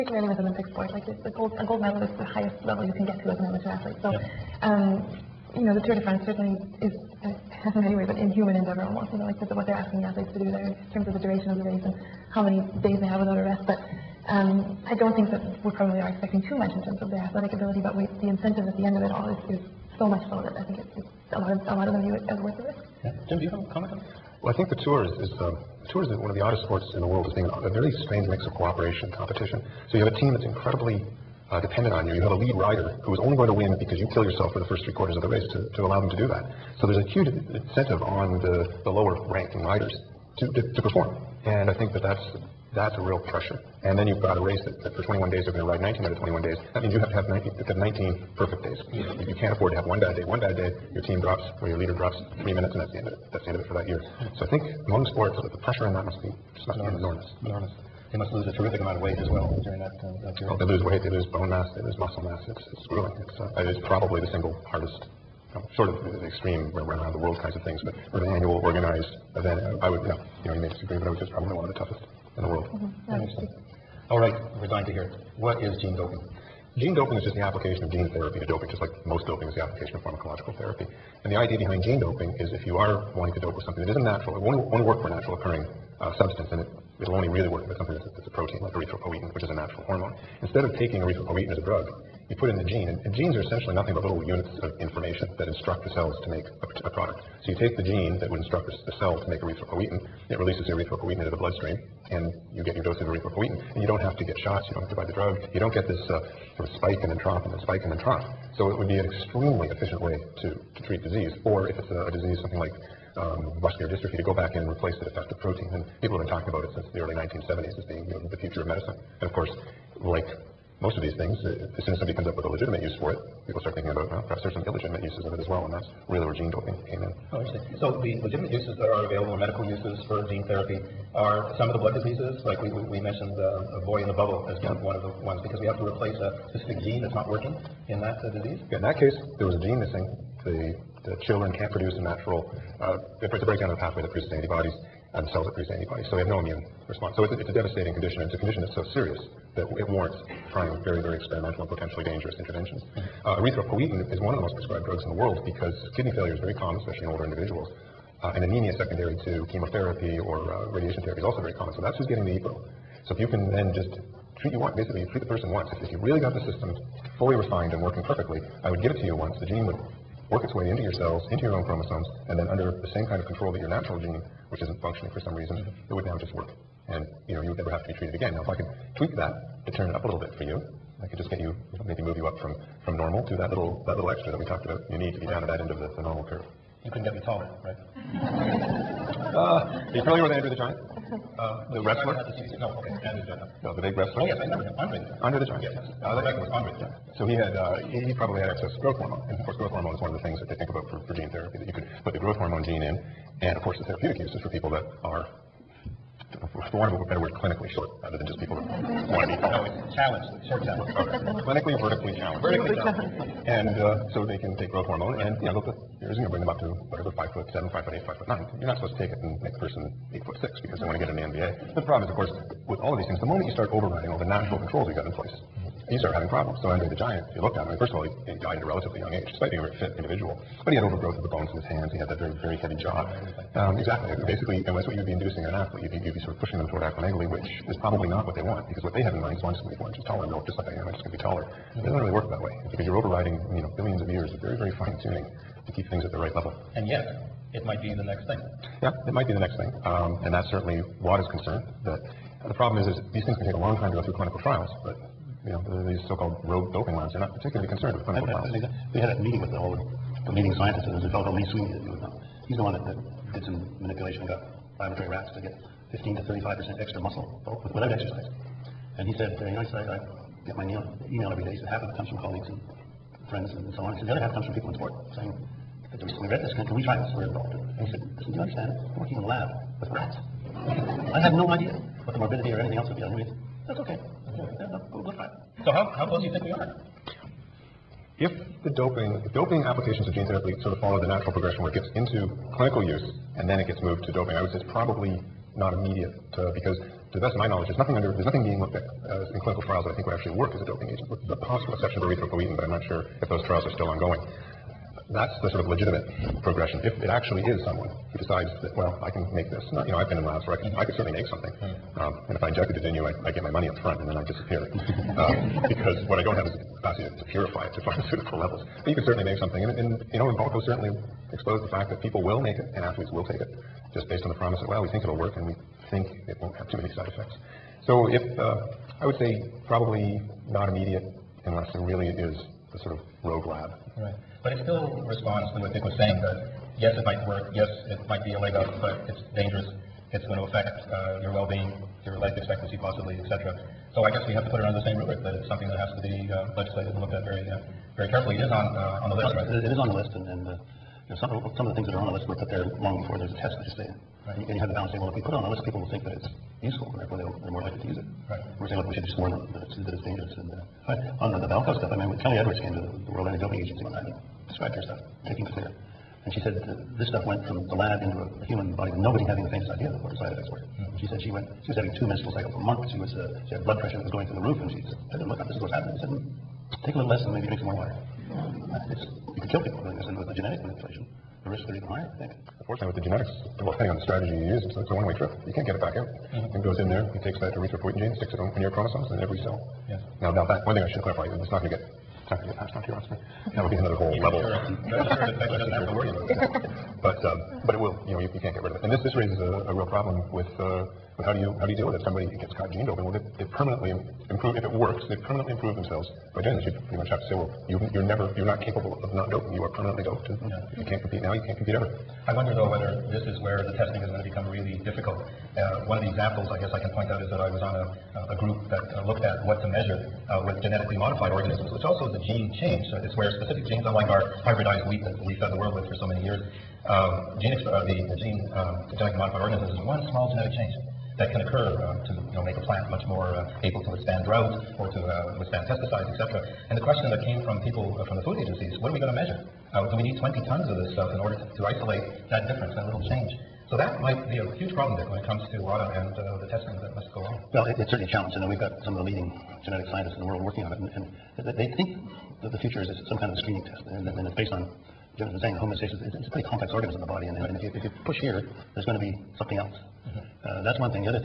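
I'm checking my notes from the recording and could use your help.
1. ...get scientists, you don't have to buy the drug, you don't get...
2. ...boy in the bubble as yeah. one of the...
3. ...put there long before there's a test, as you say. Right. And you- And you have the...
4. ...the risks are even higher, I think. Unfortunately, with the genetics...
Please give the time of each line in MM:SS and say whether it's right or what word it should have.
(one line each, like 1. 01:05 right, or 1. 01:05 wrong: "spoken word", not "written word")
1. 01:44 wrong: "shots", not "scientists"
2. 02:13 right
3. 05:52 right
4. 06:21 right.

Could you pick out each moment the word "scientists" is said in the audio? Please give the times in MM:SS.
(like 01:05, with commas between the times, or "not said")
04:20, 07:29.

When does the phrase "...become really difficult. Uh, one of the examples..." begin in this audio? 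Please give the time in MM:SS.
06:54.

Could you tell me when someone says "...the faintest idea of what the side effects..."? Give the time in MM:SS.
06:09.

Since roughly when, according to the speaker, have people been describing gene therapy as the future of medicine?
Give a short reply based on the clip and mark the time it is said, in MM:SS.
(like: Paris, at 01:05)
early 1970s, at 01:56.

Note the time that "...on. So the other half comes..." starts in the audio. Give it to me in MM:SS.
04:33.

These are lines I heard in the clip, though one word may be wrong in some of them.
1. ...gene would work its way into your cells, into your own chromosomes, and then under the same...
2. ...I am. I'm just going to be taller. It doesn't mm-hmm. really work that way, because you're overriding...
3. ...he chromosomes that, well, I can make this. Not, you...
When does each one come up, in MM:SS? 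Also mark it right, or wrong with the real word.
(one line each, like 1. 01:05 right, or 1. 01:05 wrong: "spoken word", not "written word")
1. 02:49 right
2. 04:00 right
3. 05:08 wrong: "decides", not "chromosomes".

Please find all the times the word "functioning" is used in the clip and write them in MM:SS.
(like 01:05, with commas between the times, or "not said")
02:54.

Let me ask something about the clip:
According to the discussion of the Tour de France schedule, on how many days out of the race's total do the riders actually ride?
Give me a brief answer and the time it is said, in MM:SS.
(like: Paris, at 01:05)
19, at 00:45.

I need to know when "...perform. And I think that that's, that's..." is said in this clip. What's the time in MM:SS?
00:40.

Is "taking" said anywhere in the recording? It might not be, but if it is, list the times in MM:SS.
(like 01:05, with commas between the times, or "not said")
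01:30, 06:05.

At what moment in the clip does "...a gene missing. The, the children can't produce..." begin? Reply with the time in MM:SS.
02:19.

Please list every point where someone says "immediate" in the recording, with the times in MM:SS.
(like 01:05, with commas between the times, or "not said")
04:55, 05:30.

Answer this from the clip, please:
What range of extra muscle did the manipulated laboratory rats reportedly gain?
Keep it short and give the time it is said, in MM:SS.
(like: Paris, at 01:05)
15 to 35%, at 04:25.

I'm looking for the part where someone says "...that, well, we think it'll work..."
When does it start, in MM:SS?
05:24.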